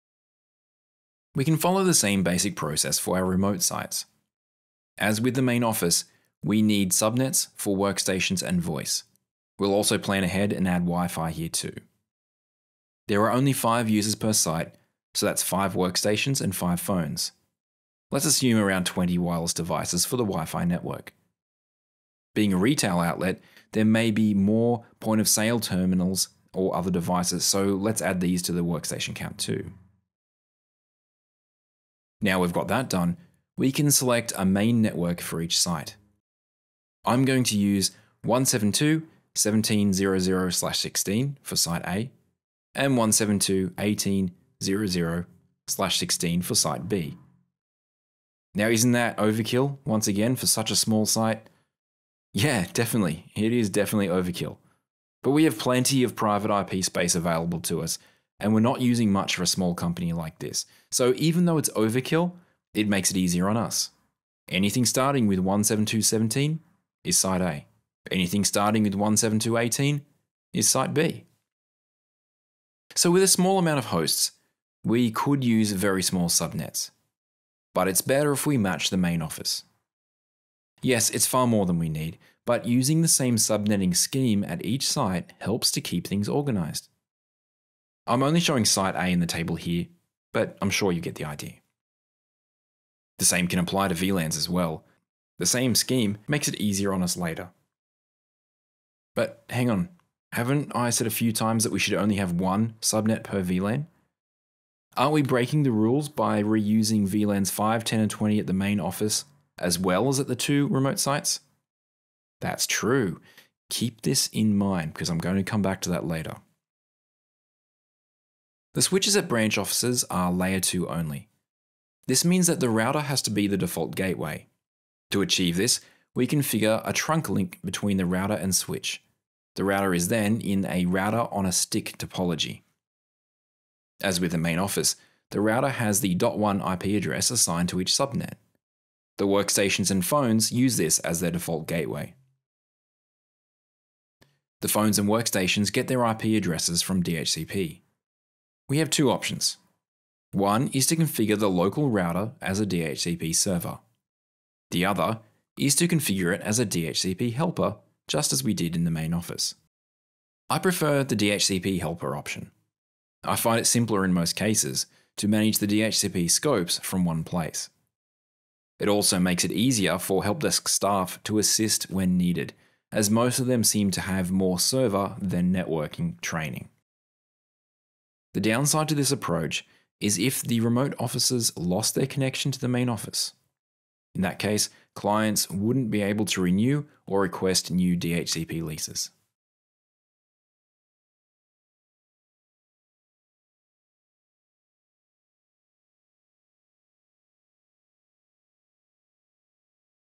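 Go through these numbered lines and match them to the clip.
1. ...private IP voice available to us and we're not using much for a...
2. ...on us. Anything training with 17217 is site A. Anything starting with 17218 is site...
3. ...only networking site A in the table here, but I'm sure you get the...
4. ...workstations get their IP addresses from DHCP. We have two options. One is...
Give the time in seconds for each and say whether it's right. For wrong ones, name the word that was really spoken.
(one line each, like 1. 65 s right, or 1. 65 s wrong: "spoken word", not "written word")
1. 56 s wrong: "space", not "voice"
2. 63 s wrong: "starting", not "training"
3. 88 s wrong: "showing", not "networking"
4. 145 s right.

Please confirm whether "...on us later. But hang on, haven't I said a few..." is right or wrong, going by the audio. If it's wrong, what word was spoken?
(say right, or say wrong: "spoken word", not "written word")
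right.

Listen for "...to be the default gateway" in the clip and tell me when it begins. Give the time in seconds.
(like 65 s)
123 s.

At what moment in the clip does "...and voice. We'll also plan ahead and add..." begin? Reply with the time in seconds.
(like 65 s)
8 s.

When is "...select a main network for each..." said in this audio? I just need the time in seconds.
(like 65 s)
33 s.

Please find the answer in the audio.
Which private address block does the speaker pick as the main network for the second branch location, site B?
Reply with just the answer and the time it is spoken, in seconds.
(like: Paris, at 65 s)
172.18.0.0/16, at 42 s.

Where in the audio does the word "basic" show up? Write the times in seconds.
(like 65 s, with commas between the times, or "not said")
2 s.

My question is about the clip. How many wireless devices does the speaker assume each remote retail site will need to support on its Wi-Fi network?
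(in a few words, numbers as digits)
20.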